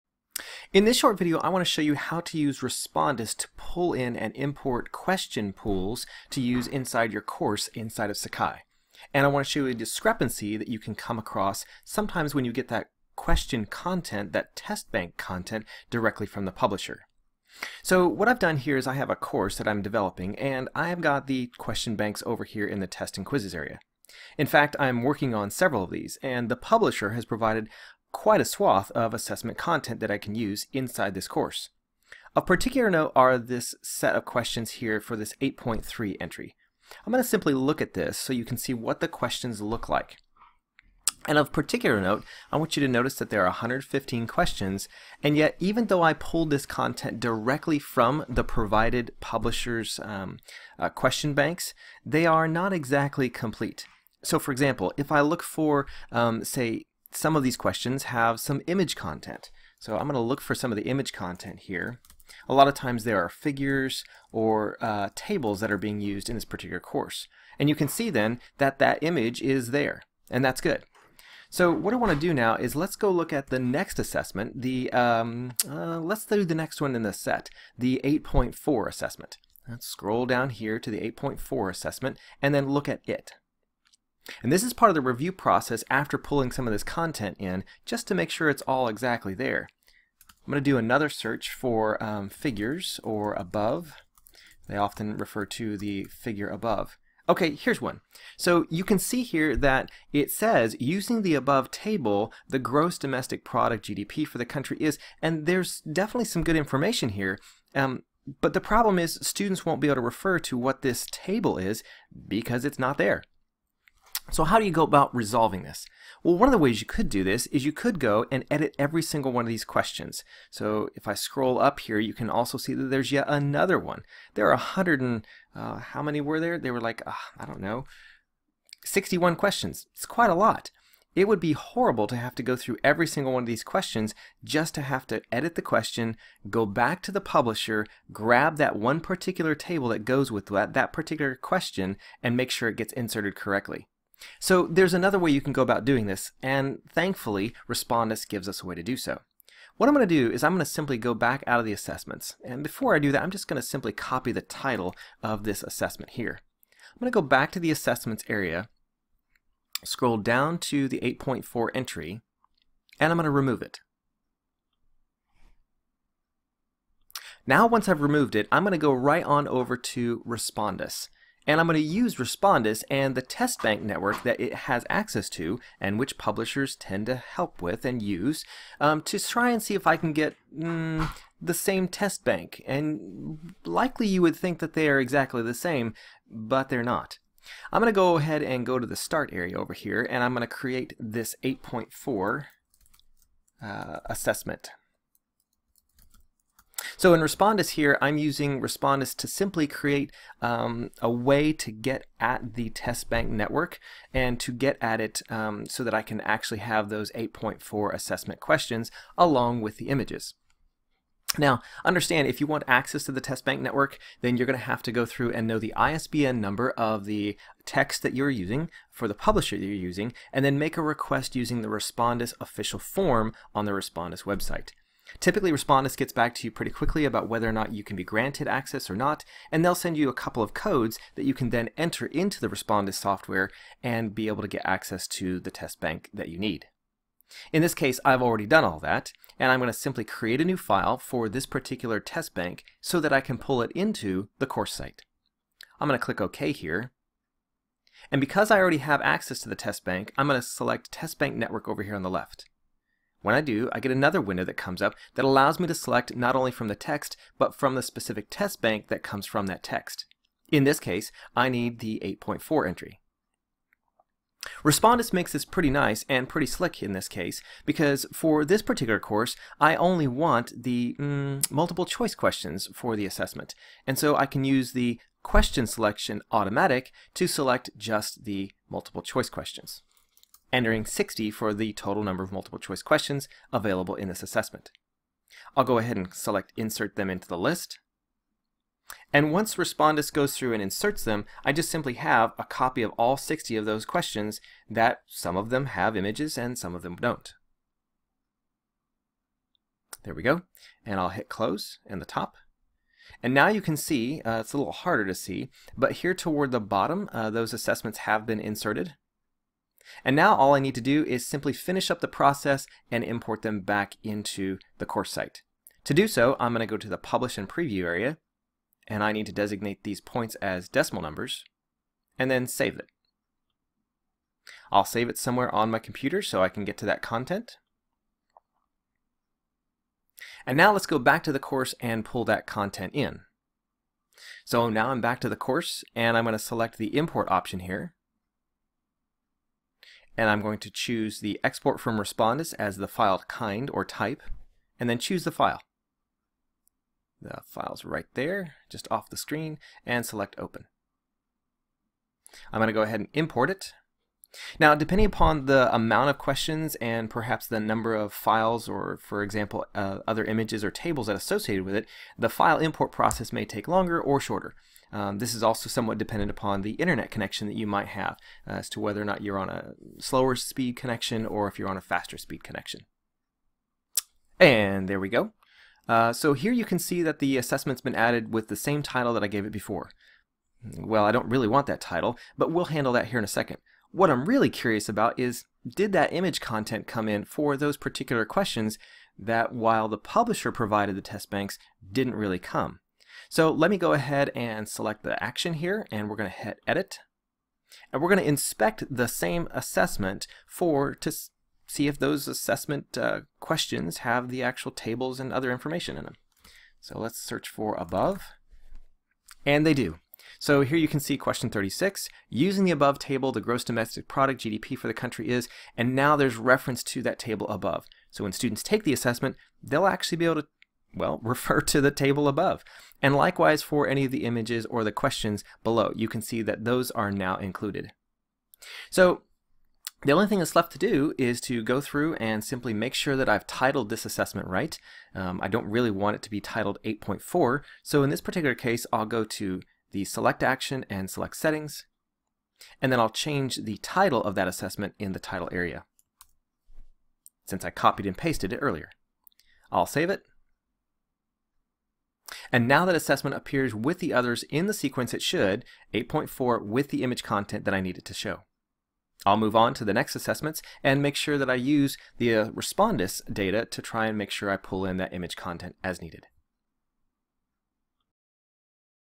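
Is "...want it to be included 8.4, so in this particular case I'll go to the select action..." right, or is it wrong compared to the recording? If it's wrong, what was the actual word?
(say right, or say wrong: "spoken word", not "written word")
wrong: "titled", not "included".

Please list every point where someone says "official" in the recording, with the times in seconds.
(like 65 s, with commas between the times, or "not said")
222 s.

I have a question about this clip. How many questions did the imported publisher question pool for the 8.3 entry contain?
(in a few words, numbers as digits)
115.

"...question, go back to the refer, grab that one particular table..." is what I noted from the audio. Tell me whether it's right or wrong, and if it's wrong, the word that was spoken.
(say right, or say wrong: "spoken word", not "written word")
wrong: "publisher", not "refer".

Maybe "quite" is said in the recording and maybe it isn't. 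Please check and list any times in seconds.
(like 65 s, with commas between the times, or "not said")
28 s, 130 s.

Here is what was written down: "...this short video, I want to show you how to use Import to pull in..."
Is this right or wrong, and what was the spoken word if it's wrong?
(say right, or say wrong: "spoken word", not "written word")
wrong: "Respondus", not "Import".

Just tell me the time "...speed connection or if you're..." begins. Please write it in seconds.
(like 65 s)
370 s.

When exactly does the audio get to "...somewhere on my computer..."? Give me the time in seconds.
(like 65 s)
325 s.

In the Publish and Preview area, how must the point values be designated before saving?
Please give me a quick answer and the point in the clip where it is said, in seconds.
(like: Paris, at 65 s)
decimal numbers, at 320 s.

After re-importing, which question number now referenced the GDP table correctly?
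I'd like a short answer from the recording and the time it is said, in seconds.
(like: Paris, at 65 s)
36, at 411 s.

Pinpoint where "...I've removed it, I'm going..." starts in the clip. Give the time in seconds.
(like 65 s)
167 s.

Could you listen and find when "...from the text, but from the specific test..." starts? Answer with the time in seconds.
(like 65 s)
256 s.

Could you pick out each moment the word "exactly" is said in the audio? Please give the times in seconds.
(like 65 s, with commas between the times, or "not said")
52 s, 88 s, 184 s.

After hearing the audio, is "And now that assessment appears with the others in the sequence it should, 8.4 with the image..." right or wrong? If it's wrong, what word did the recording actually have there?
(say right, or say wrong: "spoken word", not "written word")
right.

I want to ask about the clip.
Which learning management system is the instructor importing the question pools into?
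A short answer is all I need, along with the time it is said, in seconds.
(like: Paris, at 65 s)
Sakai, at 8 s.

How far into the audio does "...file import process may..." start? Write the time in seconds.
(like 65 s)
362 s.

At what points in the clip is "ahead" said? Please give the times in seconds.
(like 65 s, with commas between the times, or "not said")
188 s, 285 s, 352 s, 393 s.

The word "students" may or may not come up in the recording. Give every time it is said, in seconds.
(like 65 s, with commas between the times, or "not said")
109 s, 418 s.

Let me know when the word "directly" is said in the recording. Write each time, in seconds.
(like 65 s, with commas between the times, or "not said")
15 s, 47 s.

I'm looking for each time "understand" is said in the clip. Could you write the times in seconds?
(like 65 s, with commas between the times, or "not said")
211 s.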